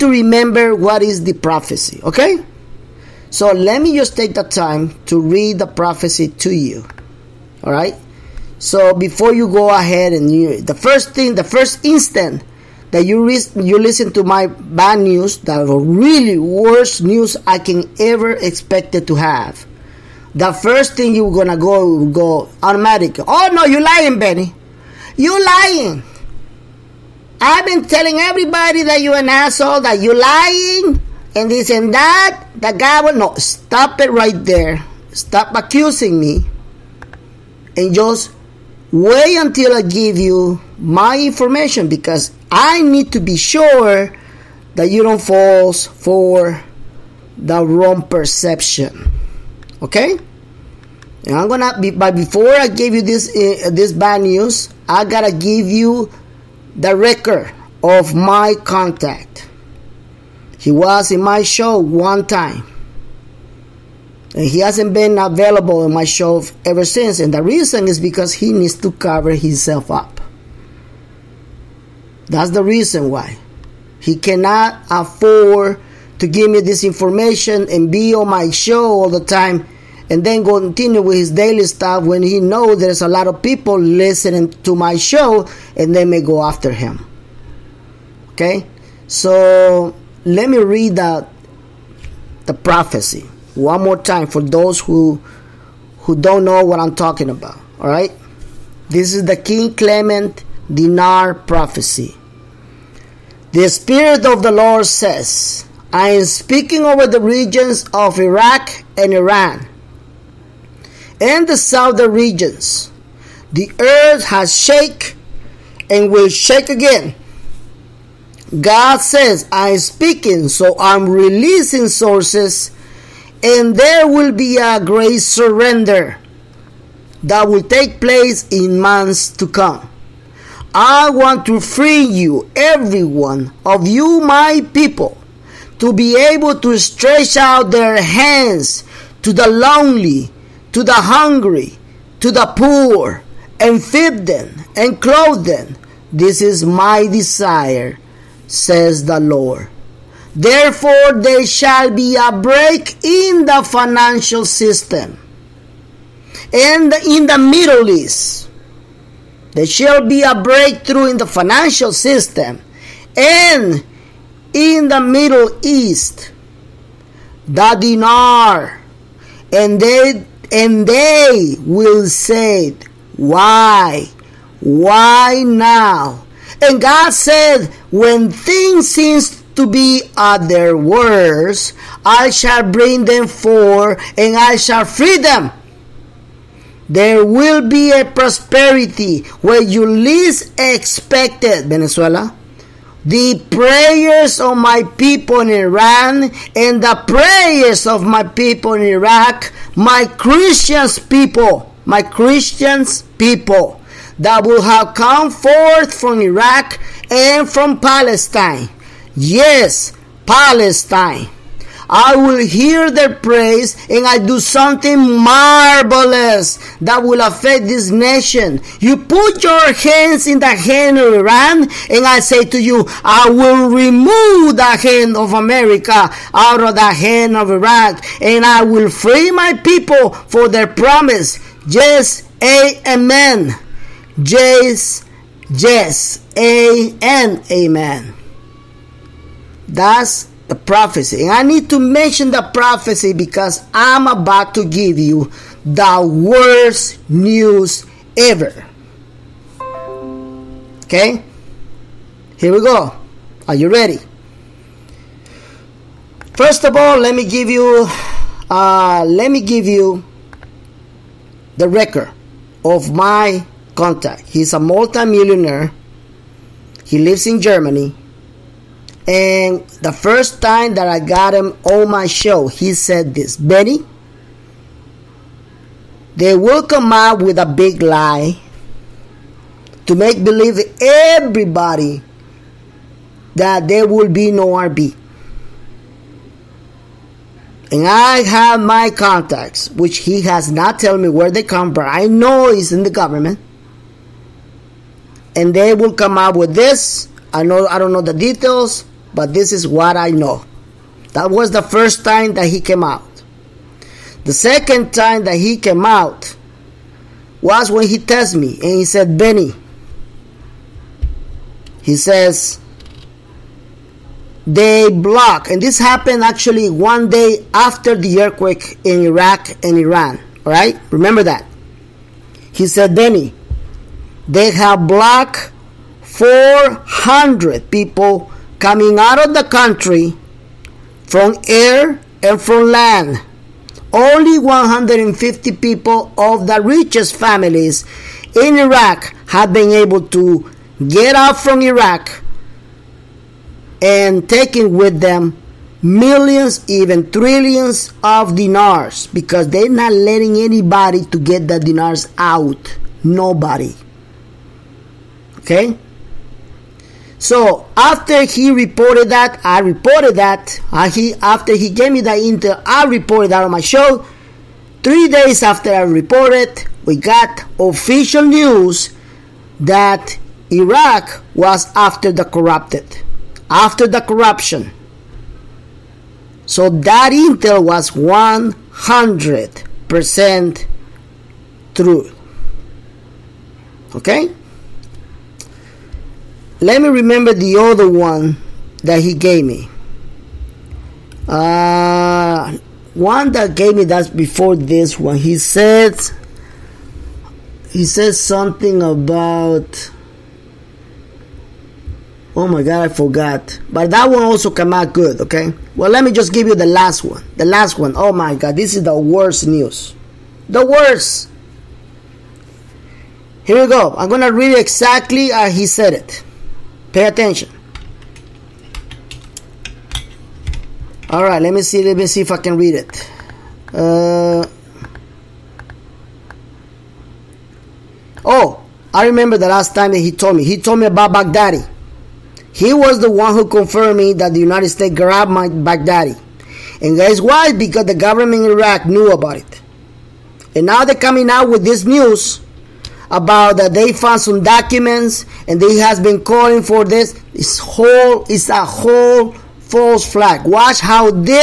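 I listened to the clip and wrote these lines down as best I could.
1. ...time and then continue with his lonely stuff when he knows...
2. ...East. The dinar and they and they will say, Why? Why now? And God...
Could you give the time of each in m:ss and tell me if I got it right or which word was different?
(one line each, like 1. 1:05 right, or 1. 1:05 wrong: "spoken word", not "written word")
1. 1:19 wrong: "daily", not "lonely"
2. 2:45 right.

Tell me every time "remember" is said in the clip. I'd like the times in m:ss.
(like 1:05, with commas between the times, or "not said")
0:00, 5:20, 6:26, 7:09.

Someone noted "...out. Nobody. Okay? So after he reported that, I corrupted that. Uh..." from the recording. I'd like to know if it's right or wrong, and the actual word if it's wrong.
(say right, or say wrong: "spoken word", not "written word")
wrong: "reported", not "corrupted".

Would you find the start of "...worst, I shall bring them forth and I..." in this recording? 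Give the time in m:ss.
3:00.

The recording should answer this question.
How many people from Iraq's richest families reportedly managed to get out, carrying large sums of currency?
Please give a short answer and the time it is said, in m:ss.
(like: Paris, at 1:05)
150, at 5:34.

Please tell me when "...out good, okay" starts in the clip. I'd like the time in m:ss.
6:44.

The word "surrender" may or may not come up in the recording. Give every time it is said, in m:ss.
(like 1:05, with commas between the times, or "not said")
2:05.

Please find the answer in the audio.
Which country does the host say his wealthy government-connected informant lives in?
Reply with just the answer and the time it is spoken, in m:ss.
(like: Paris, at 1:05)
Germany, at 4:27.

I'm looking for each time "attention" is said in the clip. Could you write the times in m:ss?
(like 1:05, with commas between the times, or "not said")
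6:57.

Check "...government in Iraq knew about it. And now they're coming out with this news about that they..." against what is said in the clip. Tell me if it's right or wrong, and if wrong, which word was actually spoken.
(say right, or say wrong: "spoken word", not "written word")
right.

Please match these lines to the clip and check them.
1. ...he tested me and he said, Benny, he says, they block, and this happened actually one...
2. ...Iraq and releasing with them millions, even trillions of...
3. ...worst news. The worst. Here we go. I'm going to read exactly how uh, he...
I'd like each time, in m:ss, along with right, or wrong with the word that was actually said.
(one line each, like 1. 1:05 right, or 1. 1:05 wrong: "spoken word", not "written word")
1. 5:07 right
2. 5:41 wrong: "taking", not "releasing"
3. 6:48 right.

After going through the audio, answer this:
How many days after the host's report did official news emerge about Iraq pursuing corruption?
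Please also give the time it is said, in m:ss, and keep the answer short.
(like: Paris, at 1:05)
3, at 6:04.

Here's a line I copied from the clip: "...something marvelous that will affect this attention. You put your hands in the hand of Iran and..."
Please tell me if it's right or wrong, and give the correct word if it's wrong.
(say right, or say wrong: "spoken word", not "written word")
wrong: "nation", not "attention".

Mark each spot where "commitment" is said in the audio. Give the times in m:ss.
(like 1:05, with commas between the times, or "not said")
not said.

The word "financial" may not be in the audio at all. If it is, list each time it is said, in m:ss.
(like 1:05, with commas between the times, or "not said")
2:33, 2:41.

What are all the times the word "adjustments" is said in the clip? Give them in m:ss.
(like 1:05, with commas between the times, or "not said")
not said.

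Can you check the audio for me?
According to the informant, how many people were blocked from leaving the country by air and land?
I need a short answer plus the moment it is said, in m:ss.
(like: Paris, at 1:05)
400, at 5:26.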